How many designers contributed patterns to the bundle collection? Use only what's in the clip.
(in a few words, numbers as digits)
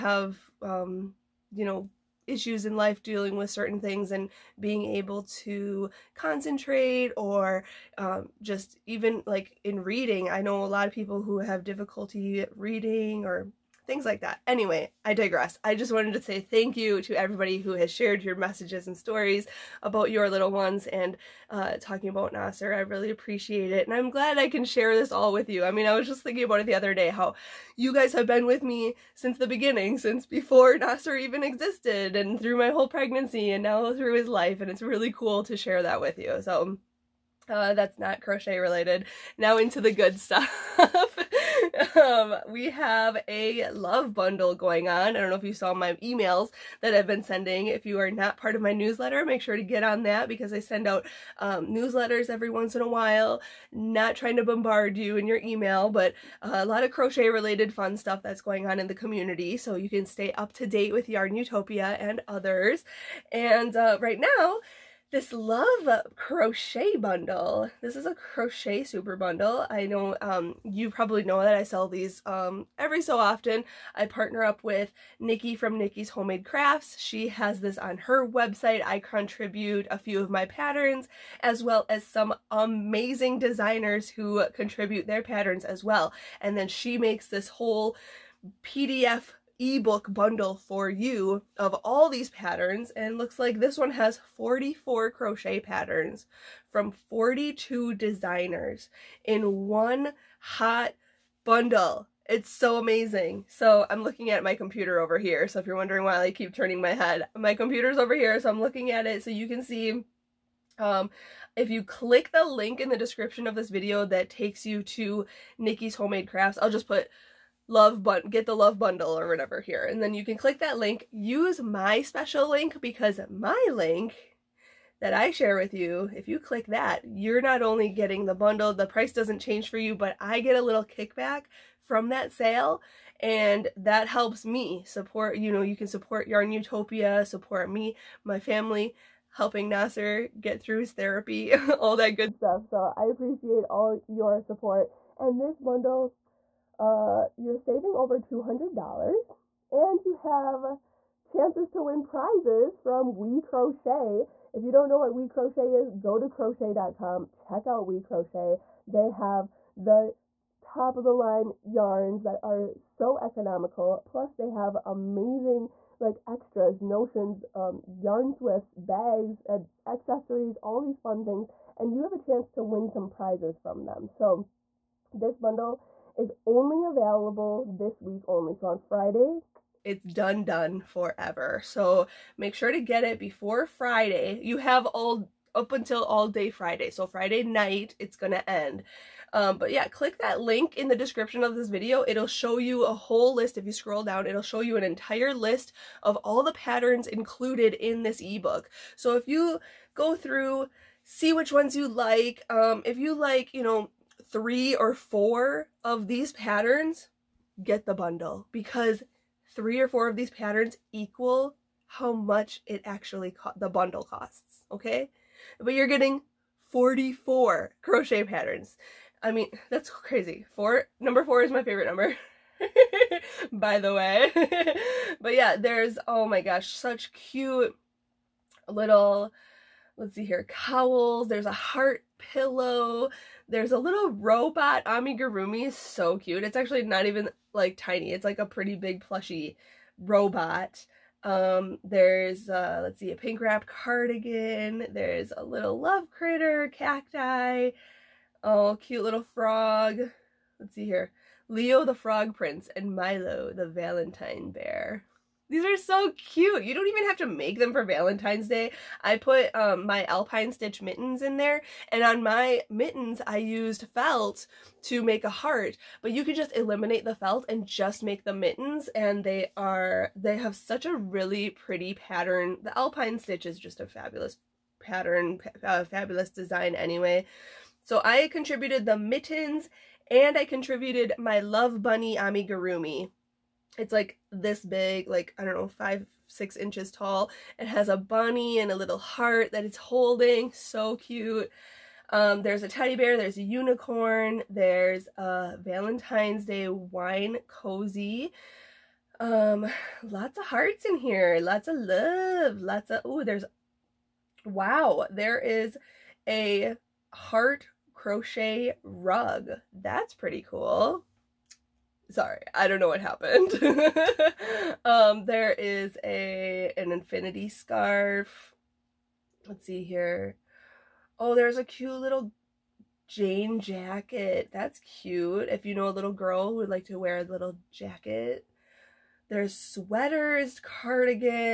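42.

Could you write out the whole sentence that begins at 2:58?
So on Friday, it's done done forever.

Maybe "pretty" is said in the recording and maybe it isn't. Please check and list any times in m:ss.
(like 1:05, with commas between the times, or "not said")
3:58, 4:31, 5:10.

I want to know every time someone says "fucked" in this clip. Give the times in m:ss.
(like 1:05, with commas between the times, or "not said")
not said.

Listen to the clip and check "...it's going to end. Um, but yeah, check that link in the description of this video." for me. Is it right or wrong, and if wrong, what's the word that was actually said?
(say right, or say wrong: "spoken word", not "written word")
wrong: "click", not "check".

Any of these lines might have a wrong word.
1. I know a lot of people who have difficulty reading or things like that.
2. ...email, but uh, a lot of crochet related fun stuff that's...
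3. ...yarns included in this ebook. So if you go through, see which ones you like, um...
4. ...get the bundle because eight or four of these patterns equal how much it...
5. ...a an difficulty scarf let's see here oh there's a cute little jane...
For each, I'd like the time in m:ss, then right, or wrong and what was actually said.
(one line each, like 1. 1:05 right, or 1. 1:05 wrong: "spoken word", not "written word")
1. 0:10 right
2. 0:55 right
3. 3:16 wrong: "patterns", not "yarns"
4. 3:27 wrong: "three", not "eight"
5. 5:16 wrong: "infinity", not "difficulty".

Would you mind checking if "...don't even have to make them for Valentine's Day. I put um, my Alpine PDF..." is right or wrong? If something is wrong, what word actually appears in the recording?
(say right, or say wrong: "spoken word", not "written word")
wrong: "Stitch", not "PDF".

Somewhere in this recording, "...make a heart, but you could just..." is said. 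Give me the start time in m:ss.
4:25.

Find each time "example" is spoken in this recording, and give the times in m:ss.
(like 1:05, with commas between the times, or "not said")
not said.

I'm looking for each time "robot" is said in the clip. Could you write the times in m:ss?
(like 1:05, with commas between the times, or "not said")
3:54, 3:59.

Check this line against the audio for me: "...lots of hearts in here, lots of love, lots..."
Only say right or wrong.
right.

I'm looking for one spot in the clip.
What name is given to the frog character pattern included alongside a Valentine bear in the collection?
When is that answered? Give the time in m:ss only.
4:11.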